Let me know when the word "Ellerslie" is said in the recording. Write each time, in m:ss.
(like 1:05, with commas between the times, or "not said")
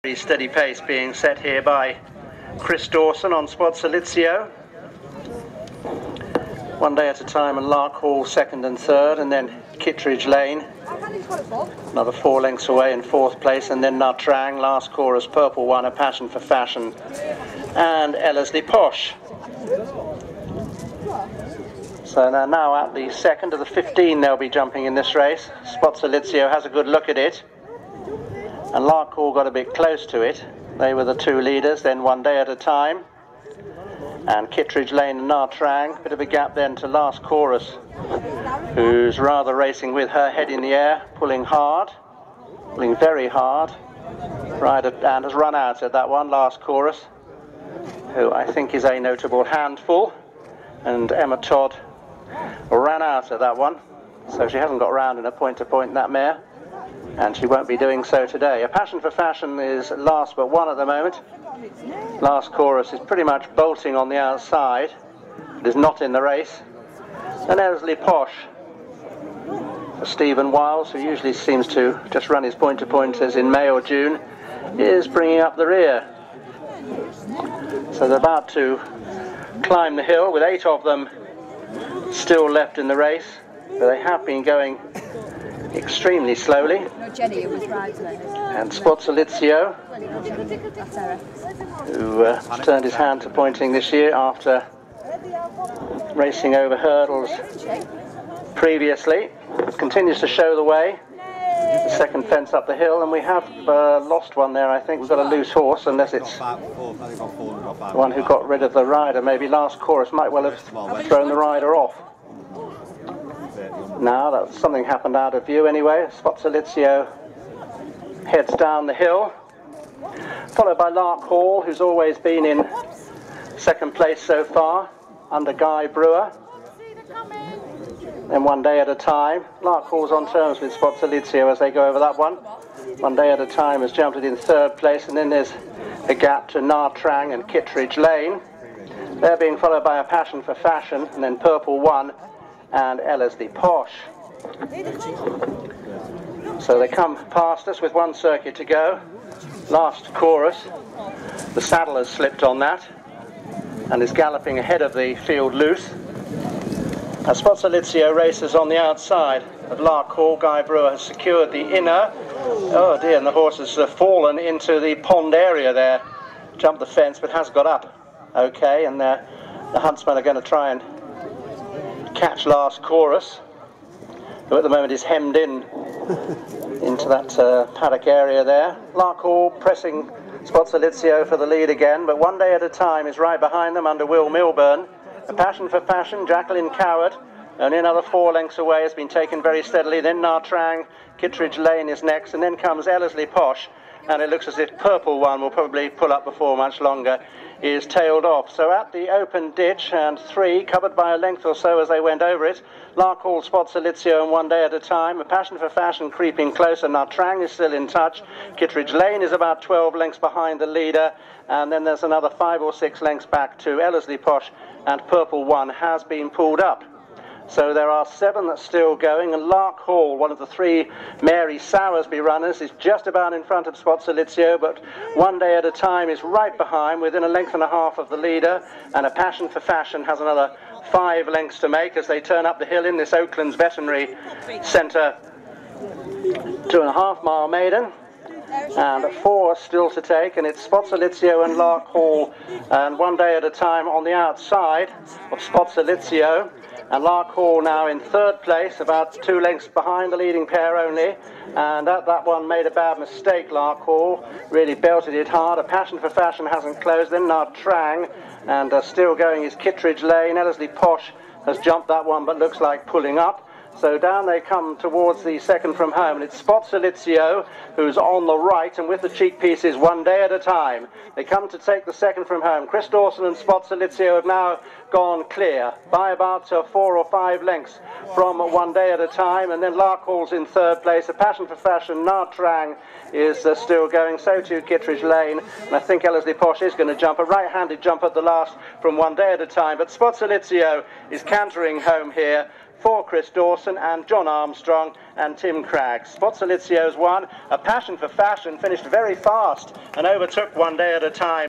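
0:18, 1:07, 2:23, 3:12, 3:33, 4:20, 4:46.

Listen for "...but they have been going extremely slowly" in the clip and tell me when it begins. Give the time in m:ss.
1:23.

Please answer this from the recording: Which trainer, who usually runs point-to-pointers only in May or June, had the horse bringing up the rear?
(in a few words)
Stephen Wiles.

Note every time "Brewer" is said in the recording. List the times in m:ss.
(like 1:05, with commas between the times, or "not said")
2:05, 2:40.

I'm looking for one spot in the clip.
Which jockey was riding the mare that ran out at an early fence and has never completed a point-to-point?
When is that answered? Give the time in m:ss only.
0:51.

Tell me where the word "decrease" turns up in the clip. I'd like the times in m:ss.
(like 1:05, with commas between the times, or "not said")
not said.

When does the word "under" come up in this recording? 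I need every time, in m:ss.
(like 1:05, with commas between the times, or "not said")
2:05, 3:03.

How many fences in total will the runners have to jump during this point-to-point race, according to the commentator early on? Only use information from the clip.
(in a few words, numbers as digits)
15.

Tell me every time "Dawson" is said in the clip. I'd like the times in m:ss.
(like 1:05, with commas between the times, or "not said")
0:02, 4:32, 4:53.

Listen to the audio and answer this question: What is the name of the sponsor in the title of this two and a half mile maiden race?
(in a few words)
Oakland's Veterinary Centre.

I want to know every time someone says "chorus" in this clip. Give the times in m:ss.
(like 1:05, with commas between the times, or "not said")
0:14, 0:37, 0:46, 1:02, 1:49, 2:30, 2:52.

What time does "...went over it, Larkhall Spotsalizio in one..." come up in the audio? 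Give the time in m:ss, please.
3:22.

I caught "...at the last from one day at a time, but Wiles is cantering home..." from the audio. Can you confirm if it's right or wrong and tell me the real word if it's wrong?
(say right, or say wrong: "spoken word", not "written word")
wrong: "Spotsalizio", not "Wiles".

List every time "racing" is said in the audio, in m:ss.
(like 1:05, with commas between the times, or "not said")
0:39, 1:36.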